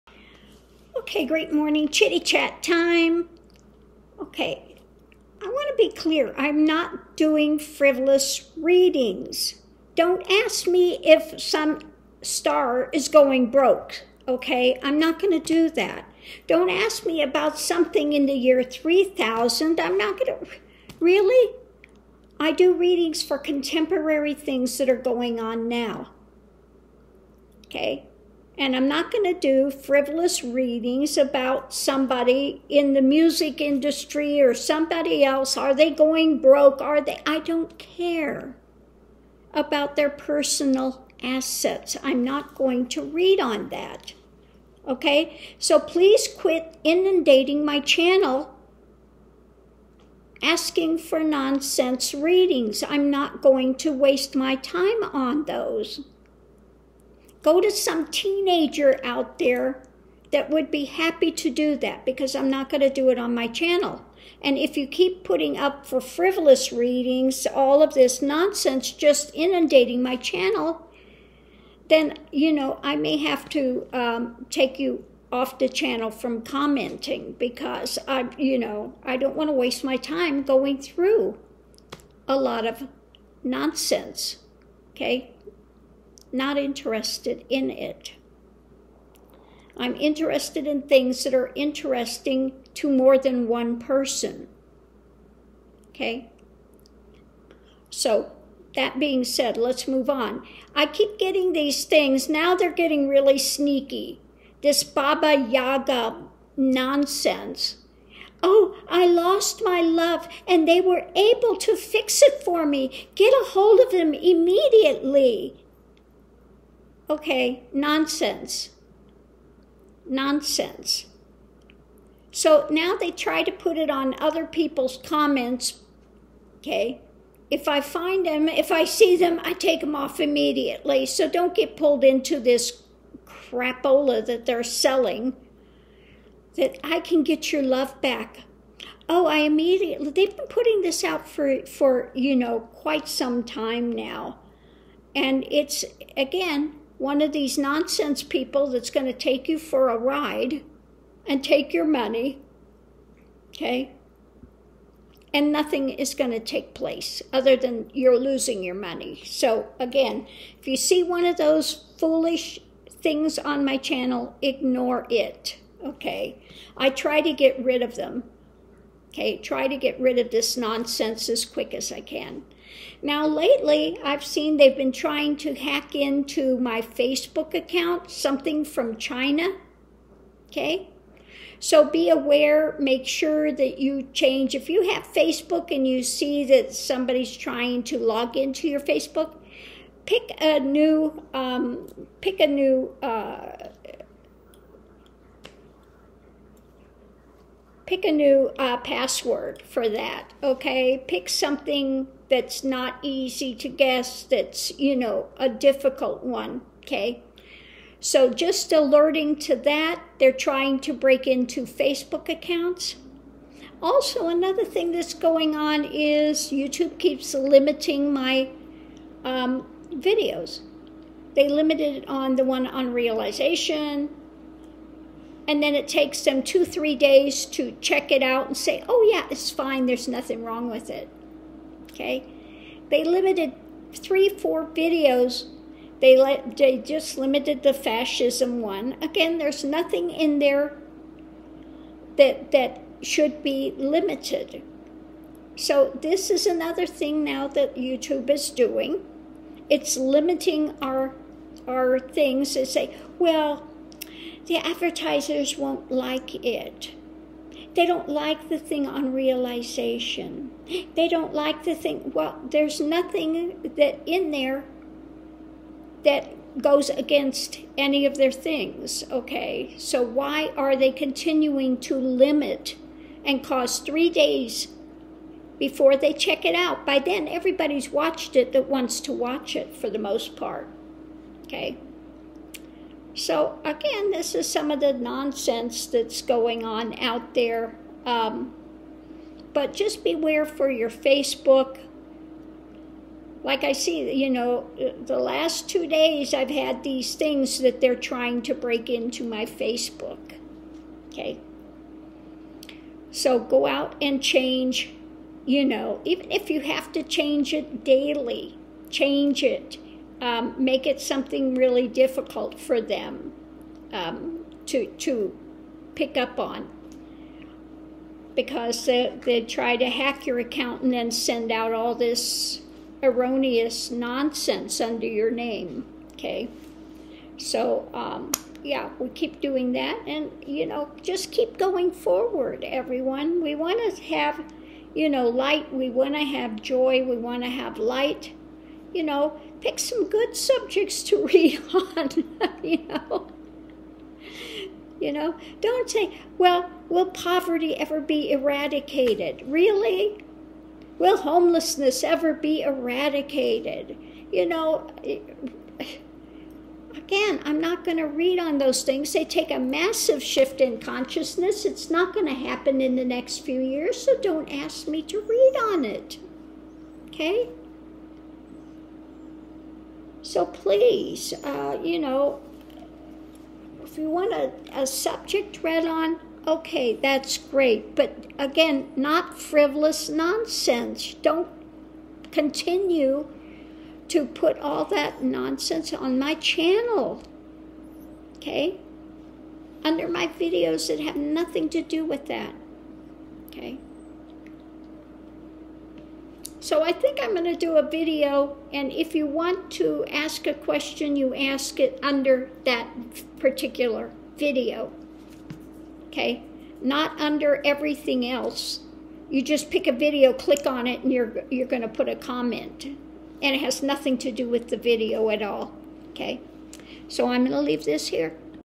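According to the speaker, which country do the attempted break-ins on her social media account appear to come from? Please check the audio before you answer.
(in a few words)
China.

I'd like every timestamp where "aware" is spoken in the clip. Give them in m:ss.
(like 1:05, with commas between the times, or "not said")
3:02.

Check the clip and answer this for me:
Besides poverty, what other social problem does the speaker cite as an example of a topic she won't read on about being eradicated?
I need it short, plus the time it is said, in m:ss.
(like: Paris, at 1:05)
homelessness, at 5:51.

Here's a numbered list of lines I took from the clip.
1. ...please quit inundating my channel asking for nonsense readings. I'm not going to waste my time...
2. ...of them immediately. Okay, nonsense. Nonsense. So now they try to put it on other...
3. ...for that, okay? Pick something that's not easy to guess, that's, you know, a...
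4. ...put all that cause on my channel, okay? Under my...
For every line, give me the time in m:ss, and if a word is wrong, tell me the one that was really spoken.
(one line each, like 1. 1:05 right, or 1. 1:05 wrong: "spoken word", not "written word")
1. 0:45 right
2. 1:53 right
3. 3:19 right
4. 6:24 wrong: "nonsense", not "cause".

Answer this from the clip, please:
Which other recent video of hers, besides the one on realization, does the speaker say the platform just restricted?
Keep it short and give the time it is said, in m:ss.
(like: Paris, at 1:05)
the fascism one, at 3:57.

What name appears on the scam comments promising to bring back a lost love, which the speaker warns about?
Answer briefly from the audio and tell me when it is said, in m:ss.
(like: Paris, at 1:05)
Baba Yaga, at 1:44.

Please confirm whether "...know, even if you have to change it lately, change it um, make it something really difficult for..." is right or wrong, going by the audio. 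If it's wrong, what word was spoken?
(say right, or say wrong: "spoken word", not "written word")
wrong: "daily", not "lately".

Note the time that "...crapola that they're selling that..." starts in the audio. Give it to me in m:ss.
2:13.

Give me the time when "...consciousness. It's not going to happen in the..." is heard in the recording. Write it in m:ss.
6:00.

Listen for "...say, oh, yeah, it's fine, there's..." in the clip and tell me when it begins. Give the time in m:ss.
3:48.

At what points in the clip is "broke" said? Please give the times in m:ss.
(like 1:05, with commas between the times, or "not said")
0:13, 0:36.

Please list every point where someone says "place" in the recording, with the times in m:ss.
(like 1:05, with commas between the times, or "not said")
2:36.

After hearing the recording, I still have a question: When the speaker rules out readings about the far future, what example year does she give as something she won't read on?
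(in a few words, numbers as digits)
3000.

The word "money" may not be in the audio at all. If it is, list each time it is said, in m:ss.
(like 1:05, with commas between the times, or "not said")
2:31, 2:38.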